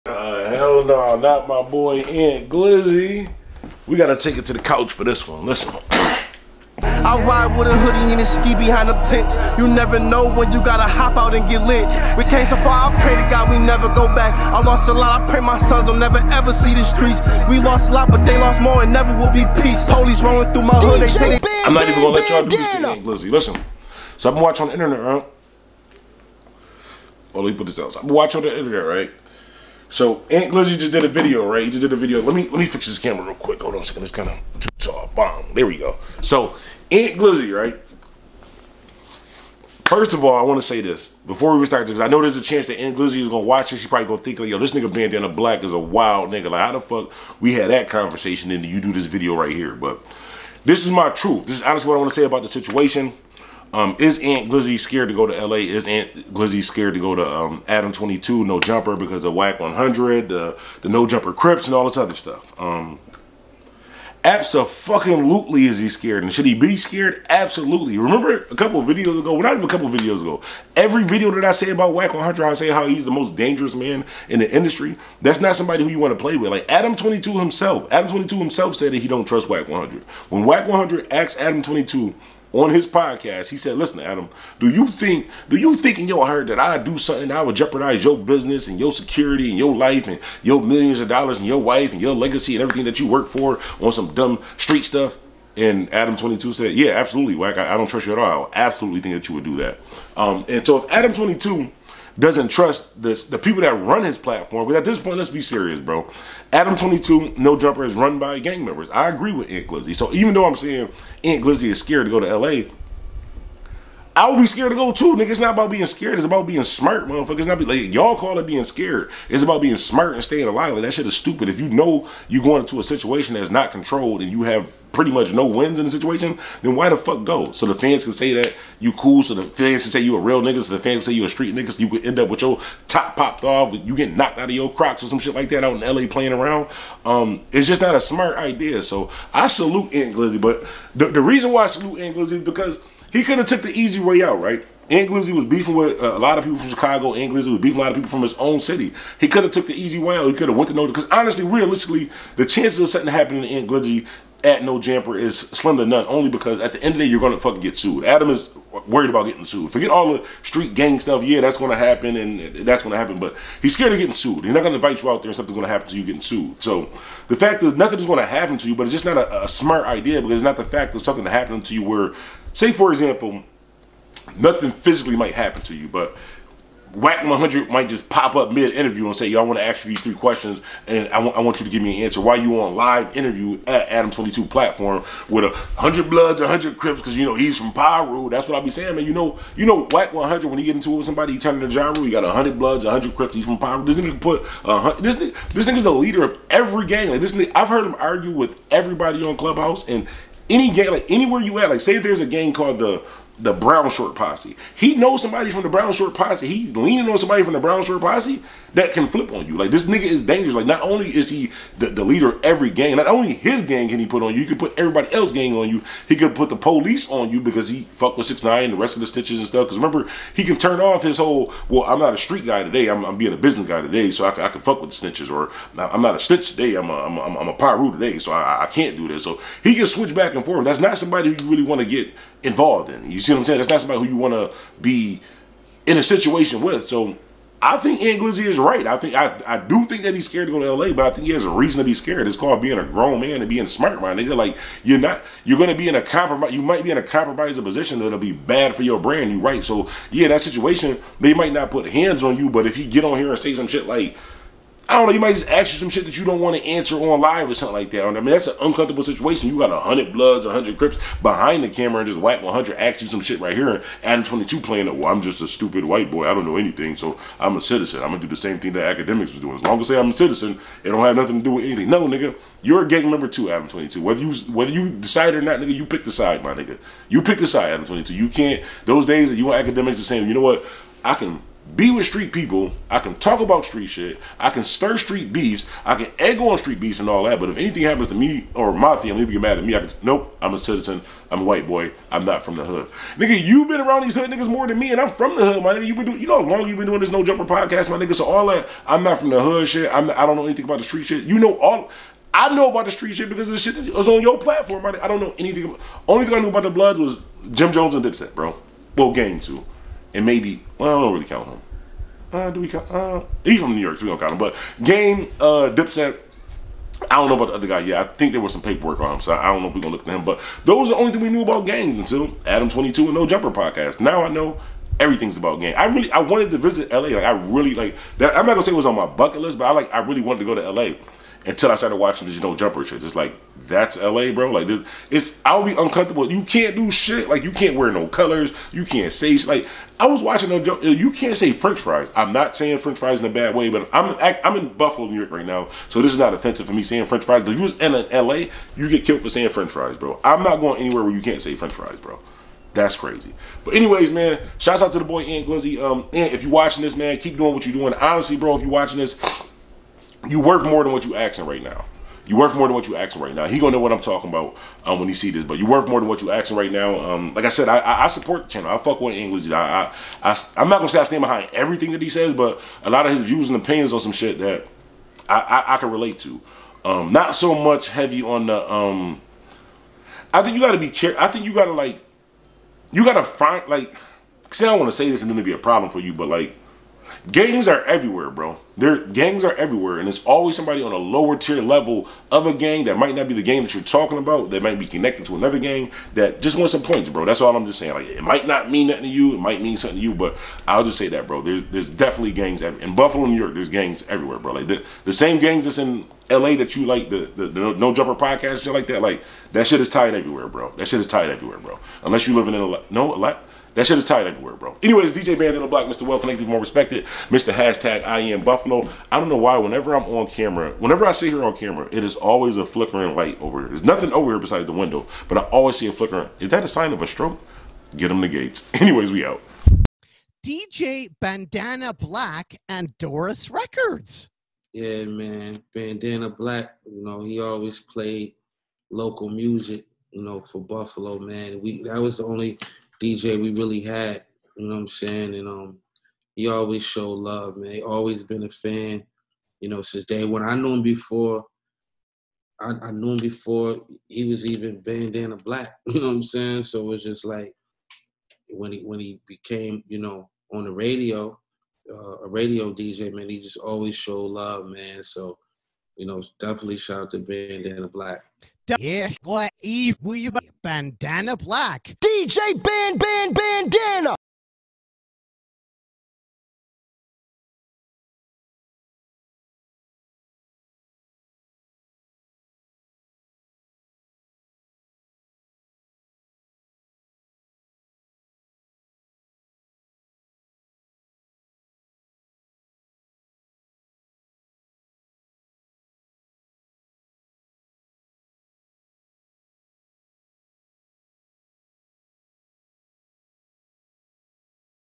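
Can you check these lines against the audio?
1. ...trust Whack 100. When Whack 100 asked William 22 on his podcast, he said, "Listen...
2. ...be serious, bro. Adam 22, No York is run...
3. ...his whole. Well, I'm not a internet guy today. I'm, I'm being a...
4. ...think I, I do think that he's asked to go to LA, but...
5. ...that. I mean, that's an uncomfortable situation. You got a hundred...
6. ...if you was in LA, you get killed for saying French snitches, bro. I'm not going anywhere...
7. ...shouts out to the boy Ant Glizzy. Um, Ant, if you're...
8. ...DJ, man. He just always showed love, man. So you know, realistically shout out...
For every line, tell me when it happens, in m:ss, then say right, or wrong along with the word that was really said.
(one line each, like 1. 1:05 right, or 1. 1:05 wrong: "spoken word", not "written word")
1. 1:19 wrong: "Adam", not "William"
2. 1:45 wrong: "Jumper", not "York"
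3. 3:41 wrong: "street", not "internet"
4. 3:58 wrong: "scared", not "asked"
5. 4:17 right
6. 5:47 wrong: "fries", not "snitches"
7. 5:54 right
8. 7:42 wrong: "definitely", not "realistically".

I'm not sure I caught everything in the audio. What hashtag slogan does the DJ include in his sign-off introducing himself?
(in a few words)
I am Buffalo.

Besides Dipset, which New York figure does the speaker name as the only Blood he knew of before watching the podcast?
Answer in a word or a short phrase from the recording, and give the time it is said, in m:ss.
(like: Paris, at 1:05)
Jim Jones, at 5:07.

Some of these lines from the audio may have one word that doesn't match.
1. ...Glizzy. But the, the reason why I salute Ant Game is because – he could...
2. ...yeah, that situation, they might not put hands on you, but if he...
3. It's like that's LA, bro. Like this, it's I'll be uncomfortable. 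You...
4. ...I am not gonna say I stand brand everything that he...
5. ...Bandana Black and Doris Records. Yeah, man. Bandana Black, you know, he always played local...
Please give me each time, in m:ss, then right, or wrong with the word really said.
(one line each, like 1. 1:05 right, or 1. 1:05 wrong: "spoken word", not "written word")
1. 2:20 wrong: "Glizzy", not "Game"
2. 4:10 right
3. 5:33 right
4. 6:10 wrong: "behind", not "brand"
5. 7:11 right.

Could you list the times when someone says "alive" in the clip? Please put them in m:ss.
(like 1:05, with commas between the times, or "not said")
2:00.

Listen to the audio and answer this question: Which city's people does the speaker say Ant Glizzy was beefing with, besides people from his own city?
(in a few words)
Chicago.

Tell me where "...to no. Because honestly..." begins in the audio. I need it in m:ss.
2:30.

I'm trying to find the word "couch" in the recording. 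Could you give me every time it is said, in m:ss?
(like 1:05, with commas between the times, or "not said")
0:04.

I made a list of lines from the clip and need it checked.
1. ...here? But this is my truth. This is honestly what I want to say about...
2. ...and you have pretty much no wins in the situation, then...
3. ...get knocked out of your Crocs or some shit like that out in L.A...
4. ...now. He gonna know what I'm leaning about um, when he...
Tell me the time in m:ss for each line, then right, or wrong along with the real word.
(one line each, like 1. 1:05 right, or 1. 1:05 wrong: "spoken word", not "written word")
1. 0:49 right
2. 2:04 right
3. 2:13 right
4. 6:03 wrong: "talking", not "leaning".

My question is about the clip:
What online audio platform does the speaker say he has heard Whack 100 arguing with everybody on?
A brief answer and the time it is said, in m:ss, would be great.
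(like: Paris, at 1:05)
Clubhouse, at 3:19.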